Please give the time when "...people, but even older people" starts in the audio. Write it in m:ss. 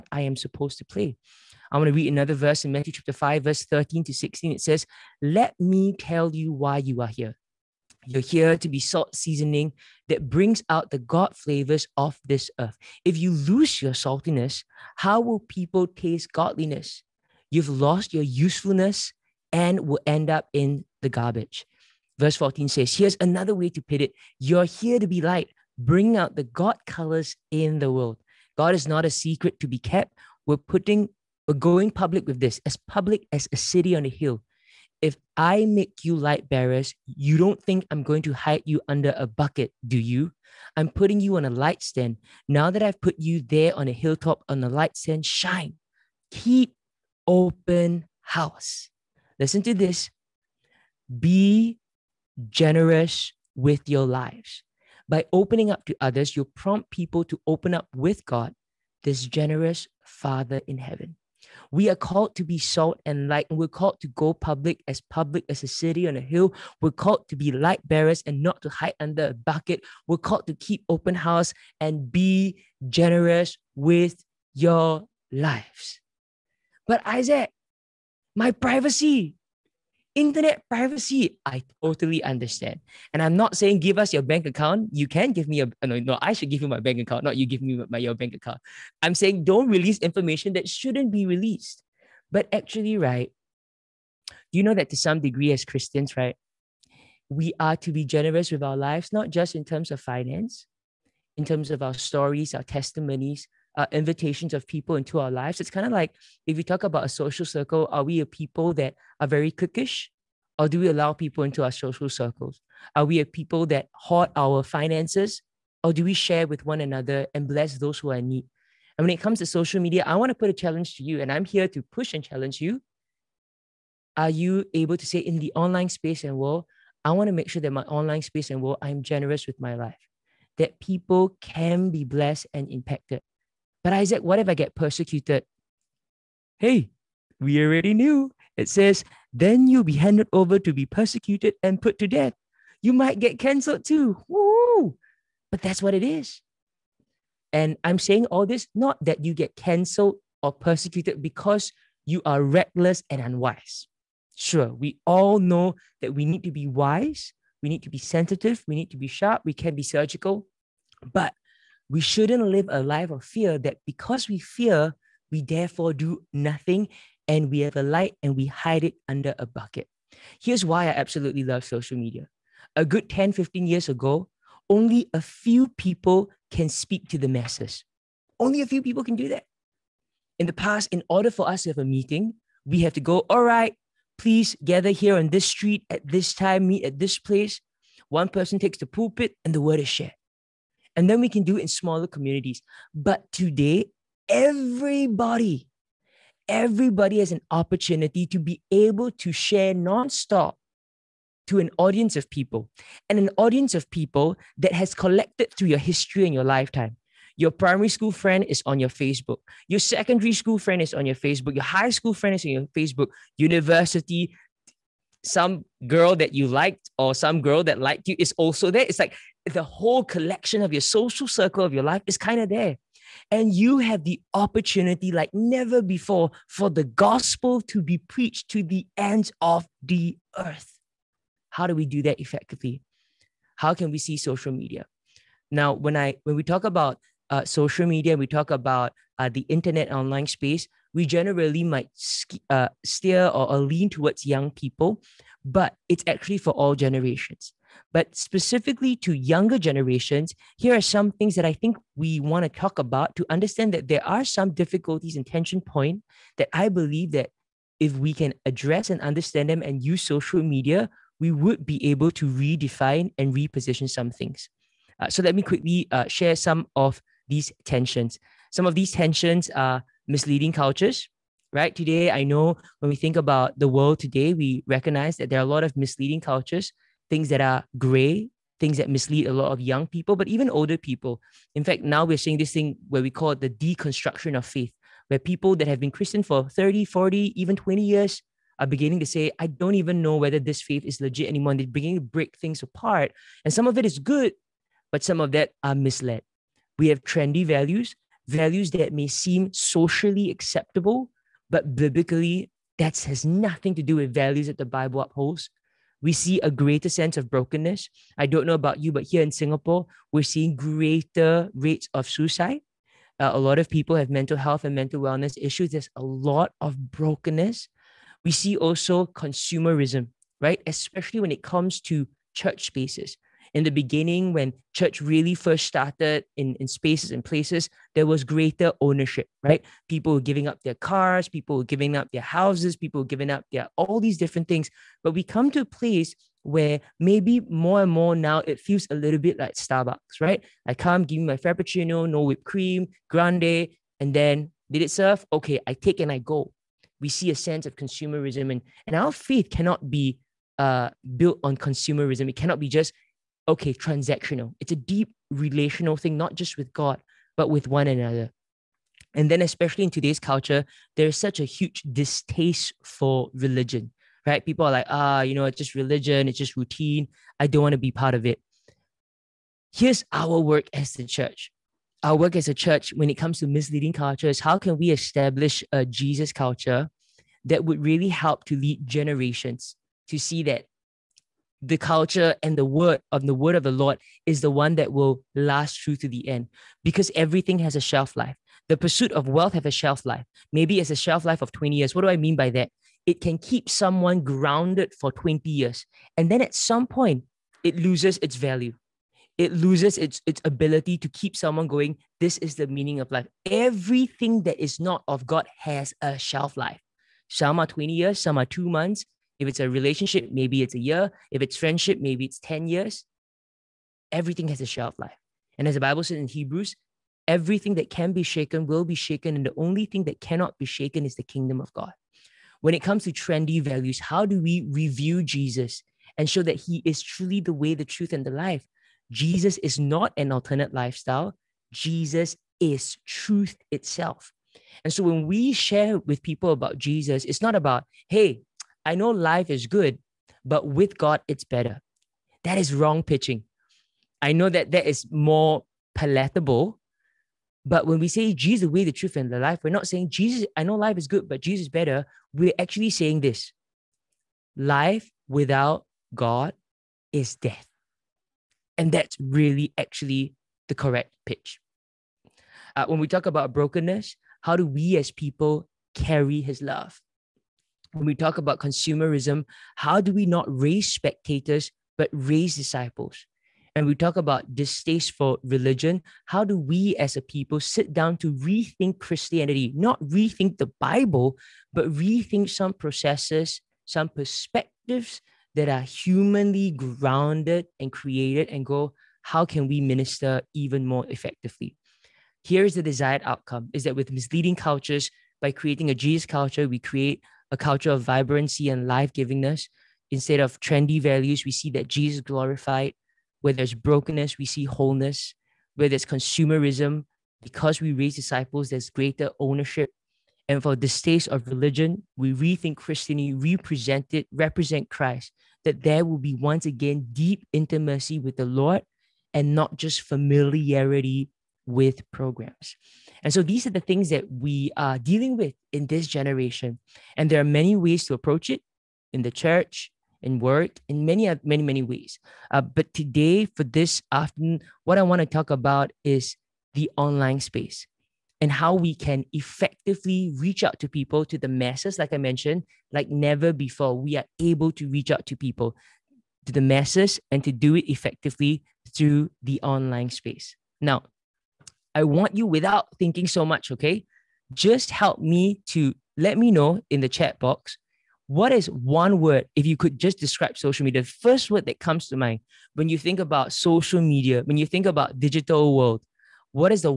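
4:39.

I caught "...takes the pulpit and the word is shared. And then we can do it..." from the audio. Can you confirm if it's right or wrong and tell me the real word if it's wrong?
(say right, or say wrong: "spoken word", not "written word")
right.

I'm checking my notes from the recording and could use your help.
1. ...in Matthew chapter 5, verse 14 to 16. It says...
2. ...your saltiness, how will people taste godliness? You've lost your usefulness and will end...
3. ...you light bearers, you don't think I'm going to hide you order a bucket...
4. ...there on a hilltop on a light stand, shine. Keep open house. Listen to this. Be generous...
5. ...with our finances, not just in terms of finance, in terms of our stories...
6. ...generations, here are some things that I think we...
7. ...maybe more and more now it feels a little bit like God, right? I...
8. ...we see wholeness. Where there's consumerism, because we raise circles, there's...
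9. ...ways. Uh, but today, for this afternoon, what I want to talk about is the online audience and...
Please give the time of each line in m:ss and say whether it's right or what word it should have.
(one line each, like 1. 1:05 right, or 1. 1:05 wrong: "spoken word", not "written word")
1. 0:02 wrong: "13", not "14"
2. 0:13 right
3. 0:36 wrong: "under", not "order"
4. 0:43 right
5. 1:38 wrong: "lives", not "finances"
6. 4:09 right
7. 5:36 wrong: "Starbucks", not "God"
8. 8:24 wrong: "disciples", not "circles"
9. 8:51 wrong: "space", not "audience".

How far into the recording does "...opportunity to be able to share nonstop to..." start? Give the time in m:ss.
3:17.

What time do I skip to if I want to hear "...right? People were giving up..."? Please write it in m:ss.
5:29.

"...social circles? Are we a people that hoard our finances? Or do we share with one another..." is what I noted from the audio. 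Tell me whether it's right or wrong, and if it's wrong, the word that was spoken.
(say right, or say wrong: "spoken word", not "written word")
right.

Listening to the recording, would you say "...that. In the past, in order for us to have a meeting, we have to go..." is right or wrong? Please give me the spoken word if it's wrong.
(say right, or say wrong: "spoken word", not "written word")
right.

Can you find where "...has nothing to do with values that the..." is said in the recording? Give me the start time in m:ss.
5:02.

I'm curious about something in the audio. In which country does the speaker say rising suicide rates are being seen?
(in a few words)
Singapore.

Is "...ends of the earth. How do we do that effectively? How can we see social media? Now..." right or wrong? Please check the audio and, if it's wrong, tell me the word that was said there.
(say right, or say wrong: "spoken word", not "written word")
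right.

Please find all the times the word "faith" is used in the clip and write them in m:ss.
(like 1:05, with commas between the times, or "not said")
4:44, 4:50, 5:49.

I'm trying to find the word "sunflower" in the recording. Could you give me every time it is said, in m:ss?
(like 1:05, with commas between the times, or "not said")
not said.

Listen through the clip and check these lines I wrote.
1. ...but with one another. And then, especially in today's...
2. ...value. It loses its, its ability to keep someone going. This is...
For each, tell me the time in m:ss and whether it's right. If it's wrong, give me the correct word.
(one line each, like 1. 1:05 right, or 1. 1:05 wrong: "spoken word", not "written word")
1. 5:57 right
2. 6:38 right.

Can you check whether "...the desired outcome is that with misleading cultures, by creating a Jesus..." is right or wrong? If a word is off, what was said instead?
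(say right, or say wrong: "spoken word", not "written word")
right.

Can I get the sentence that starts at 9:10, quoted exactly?
Now, I want you without thinking so much, okay?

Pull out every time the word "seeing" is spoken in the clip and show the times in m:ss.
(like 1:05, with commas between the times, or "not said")
4:42, 5:10.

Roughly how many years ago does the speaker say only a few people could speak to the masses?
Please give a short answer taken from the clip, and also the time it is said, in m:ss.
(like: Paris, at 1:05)
10, 15 years, at 2:53.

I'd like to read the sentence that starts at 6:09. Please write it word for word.
Here's our work as the church.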